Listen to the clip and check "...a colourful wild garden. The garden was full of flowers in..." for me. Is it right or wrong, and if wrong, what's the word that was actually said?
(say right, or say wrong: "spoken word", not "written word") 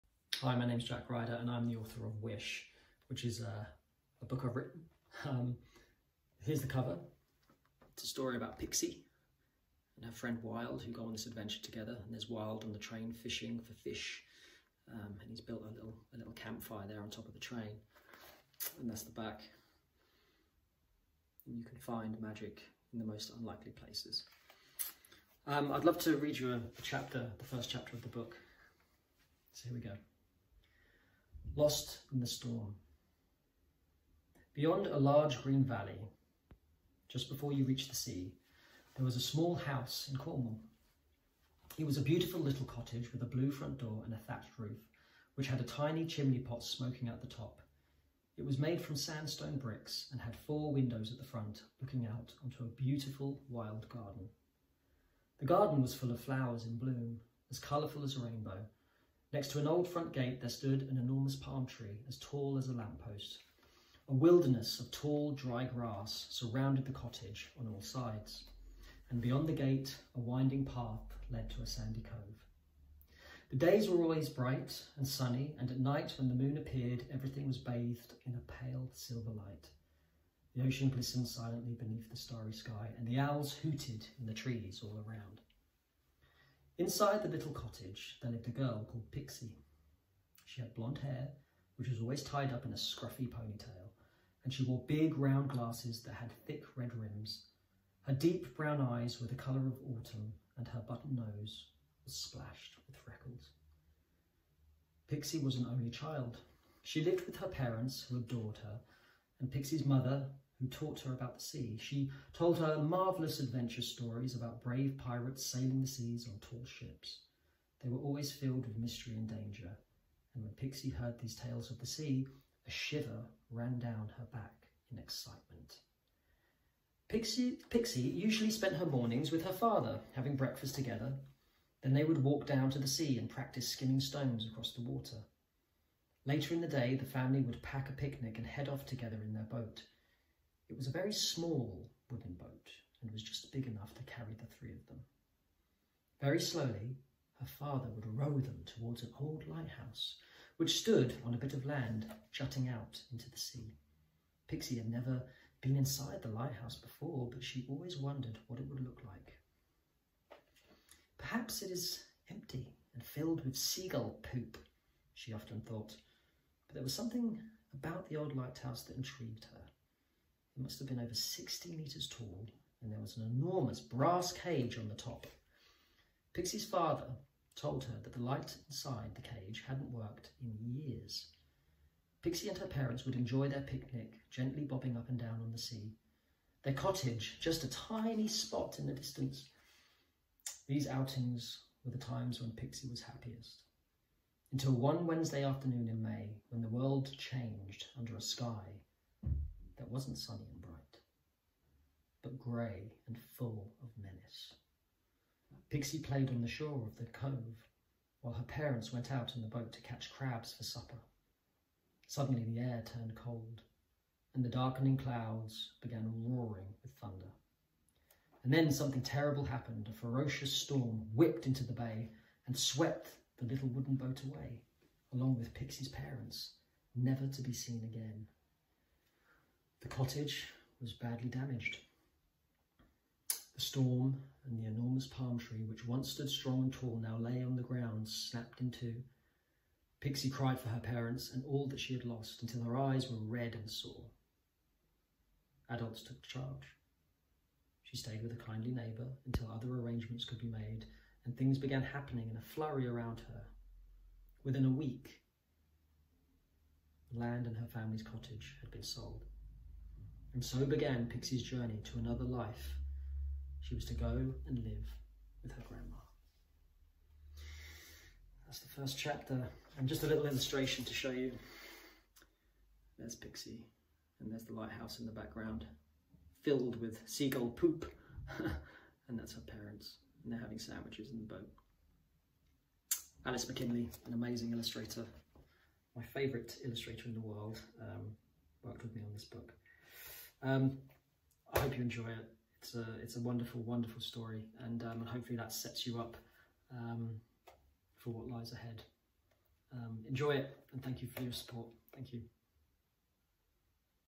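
wrong: "beautiful", not "colourful".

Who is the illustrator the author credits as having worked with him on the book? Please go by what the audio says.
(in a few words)
Alice McKinley.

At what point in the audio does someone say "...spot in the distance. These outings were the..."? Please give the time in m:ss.
3:08.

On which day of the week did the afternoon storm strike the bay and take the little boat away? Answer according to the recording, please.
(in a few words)
Wednesday.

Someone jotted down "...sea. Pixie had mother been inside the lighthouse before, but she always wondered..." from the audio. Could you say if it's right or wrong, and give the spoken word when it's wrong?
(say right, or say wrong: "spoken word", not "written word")
wrong: "never", not "mother".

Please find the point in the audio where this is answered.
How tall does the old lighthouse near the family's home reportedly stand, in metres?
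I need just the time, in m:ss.
2:50.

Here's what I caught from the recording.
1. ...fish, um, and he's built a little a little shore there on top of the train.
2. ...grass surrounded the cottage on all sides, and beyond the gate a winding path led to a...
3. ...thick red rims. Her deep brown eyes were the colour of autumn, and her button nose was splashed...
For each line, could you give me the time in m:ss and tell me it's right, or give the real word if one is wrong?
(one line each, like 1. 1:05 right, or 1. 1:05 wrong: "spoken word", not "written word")
1. 0:13 wrong: "campfire", not "shore"
2. 1:05 right
3. 1:36 right.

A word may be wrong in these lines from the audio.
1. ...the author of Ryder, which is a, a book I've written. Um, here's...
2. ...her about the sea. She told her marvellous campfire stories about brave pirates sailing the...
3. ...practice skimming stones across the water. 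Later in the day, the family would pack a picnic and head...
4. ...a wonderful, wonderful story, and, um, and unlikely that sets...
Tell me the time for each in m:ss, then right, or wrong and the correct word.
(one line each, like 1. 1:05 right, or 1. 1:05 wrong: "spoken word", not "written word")
1. 0:01 wrong: "Wish", not "Ryder"
2. 1:51 wrong: "adventure", not "campfire"
3. 2:13 right
4. 4:53 wrong: "hopefully", not "unlikely".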